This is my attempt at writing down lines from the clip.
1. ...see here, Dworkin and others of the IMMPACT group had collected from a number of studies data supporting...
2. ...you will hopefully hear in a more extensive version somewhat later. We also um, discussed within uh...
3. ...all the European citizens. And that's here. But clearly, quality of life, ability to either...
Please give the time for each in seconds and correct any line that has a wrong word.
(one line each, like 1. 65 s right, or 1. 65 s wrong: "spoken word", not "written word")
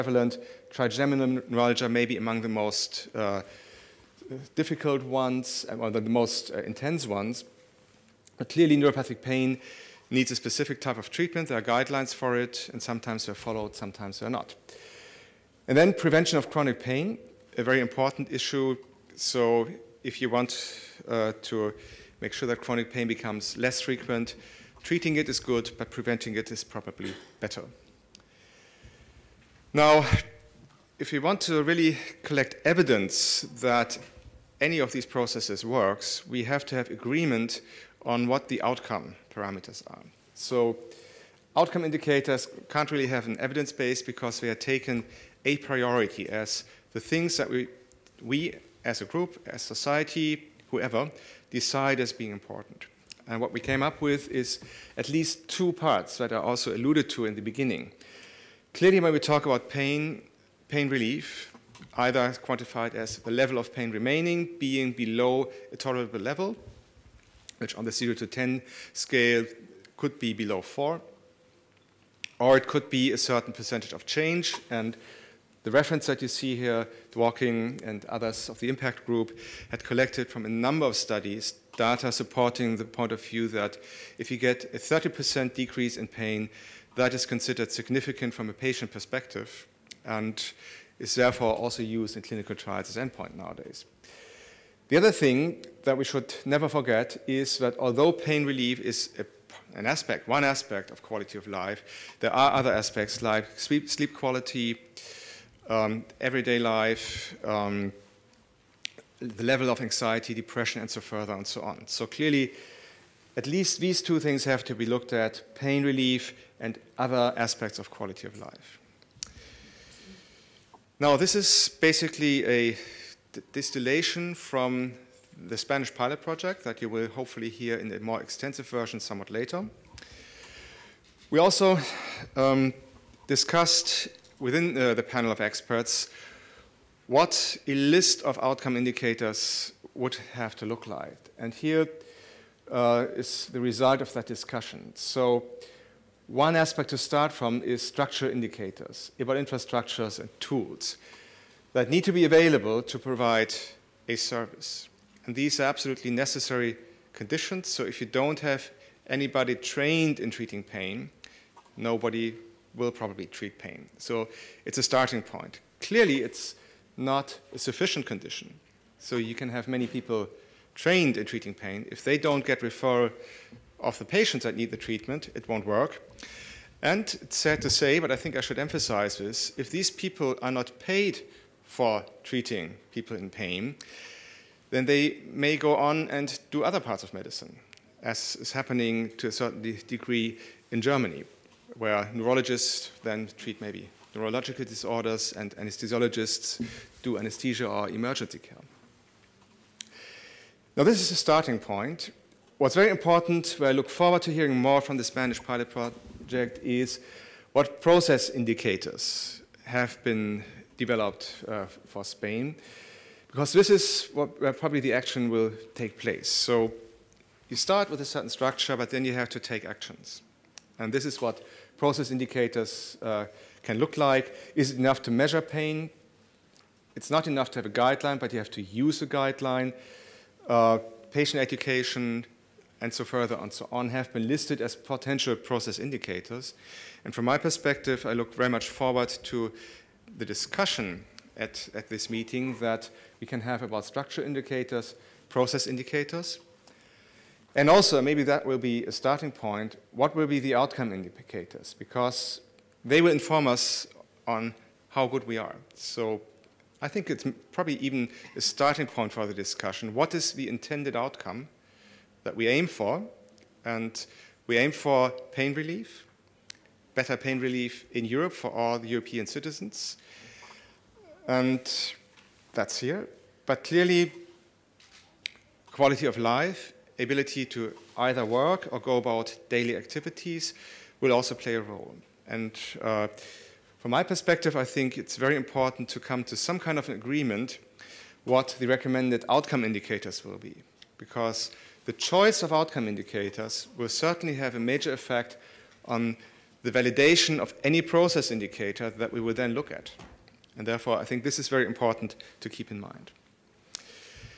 1. 76 s right
2. 126 s right
3. 268 s right.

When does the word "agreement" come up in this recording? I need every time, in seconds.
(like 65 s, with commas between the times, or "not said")
36 s, 286 s.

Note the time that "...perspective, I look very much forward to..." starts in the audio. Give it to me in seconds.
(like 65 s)
237 s.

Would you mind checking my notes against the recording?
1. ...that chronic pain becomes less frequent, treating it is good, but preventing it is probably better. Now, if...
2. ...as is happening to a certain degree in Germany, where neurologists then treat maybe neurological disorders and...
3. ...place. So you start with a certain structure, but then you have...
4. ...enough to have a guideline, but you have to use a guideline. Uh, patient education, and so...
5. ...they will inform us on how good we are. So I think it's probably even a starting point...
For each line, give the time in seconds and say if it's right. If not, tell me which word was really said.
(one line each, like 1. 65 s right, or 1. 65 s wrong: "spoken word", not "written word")
1. 22 s right
2. 188 s right
3. 215 s right
4. 227 s right
5. 252 s right.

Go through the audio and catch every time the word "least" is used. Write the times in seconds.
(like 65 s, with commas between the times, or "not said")
55 s, 113 s.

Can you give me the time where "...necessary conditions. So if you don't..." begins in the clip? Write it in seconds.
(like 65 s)
156 s.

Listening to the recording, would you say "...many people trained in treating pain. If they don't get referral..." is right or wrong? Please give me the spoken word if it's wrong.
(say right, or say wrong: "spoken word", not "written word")
right.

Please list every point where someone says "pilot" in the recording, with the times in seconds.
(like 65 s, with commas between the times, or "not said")
125 s, 205 s.